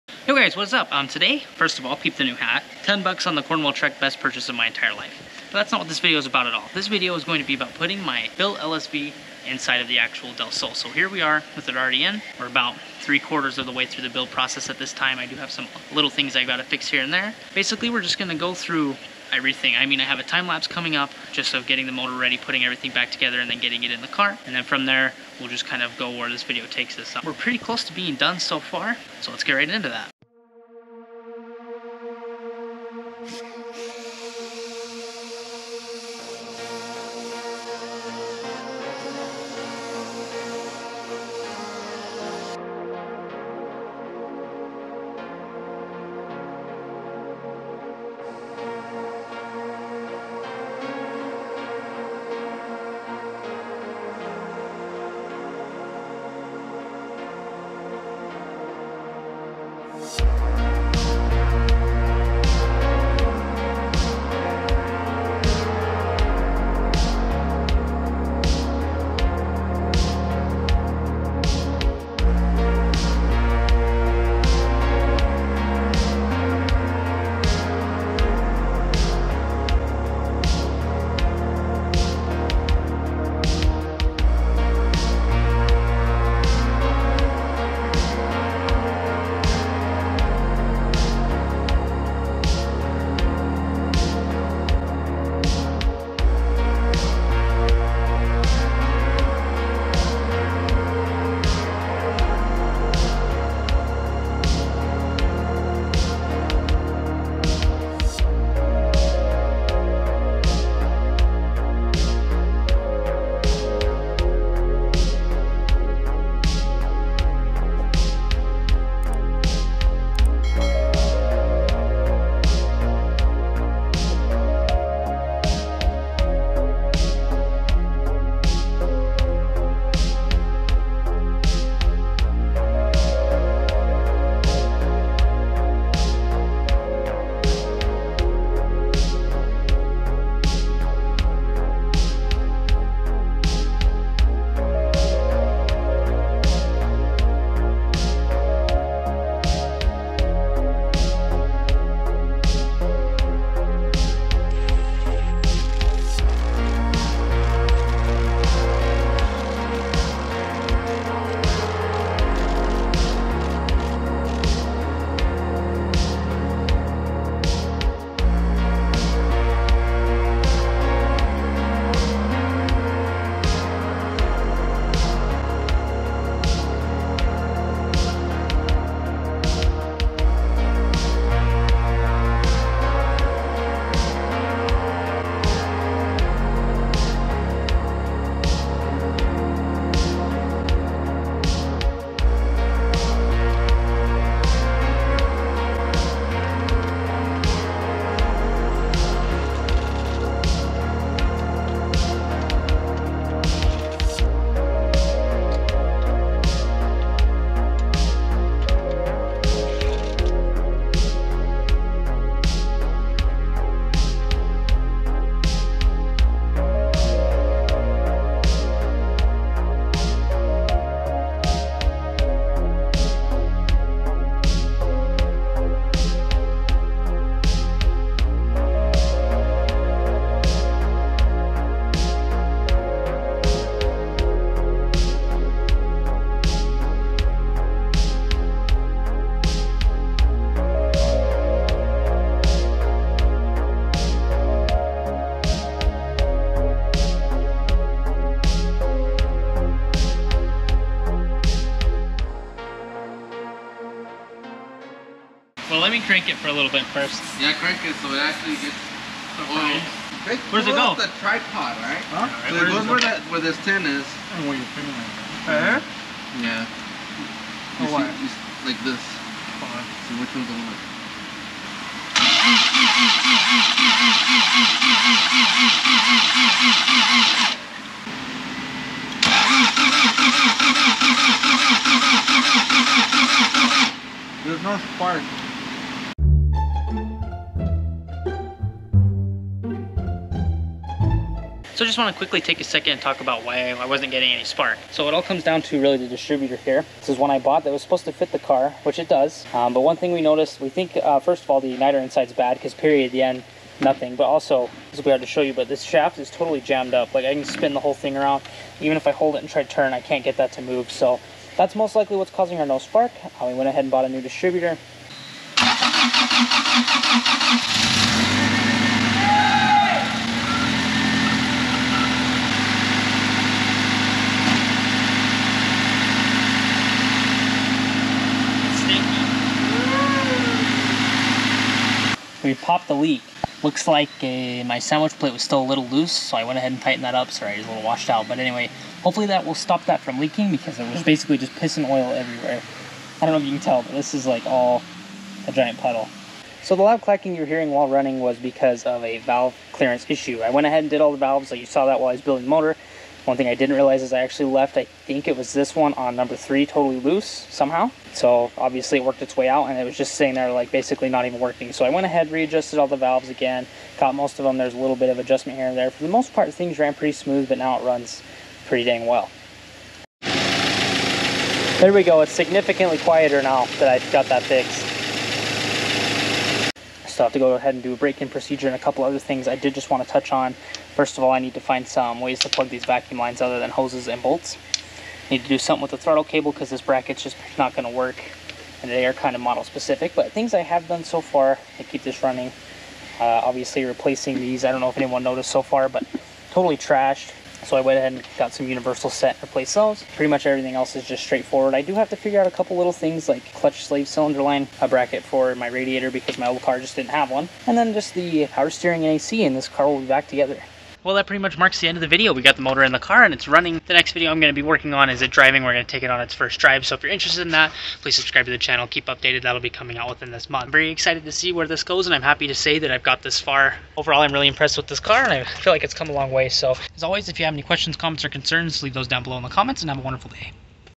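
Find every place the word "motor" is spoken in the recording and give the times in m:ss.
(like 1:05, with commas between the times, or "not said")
0:21, 5:52, 6:52.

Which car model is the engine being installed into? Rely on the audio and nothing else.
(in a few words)
Del Sol.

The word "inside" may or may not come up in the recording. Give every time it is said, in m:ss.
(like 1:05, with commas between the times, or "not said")
0:09, 5:01.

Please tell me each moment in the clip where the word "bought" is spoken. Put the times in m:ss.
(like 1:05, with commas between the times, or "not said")
4:57, 5:13.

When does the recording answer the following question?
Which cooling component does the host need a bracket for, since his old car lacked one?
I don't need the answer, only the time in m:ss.
6:45.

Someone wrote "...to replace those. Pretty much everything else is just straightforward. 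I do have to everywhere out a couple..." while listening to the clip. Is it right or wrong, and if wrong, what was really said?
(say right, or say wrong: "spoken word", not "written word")
wrong: "figure", not "everywhere".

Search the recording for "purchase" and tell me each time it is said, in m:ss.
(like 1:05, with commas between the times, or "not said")
0:04.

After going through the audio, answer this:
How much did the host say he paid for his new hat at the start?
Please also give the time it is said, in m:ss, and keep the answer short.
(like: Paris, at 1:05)
$10, at 0:02.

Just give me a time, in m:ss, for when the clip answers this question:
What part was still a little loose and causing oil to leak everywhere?
5:34.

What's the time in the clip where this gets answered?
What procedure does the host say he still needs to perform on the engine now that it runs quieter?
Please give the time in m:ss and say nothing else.
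6:17.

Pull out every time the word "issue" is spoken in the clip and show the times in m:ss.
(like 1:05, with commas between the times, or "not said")
5:50.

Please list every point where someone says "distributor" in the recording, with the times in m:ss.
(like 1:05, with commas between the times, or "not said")
4:56, 5:14.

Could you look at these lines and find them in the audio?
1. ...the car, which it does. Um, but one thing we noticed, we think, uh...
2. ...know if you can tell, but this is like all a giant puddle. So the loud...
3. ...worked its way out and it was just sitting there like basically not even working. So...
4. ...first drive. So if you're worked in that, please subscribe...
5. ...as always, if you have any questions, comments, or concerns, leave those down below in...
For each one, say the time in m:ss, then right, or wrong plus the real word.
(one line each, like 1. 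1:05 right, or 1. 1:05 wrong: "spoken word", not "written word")
1. 4:58 right
2. 5:43 right
3. 5:59 right
4. 6:56 wrong: "interested", not "worked"
5. 7:06 right.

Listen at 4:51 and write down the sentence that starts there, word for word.
So I just want to quickly take a second and talk about why I wasn't getting any spark.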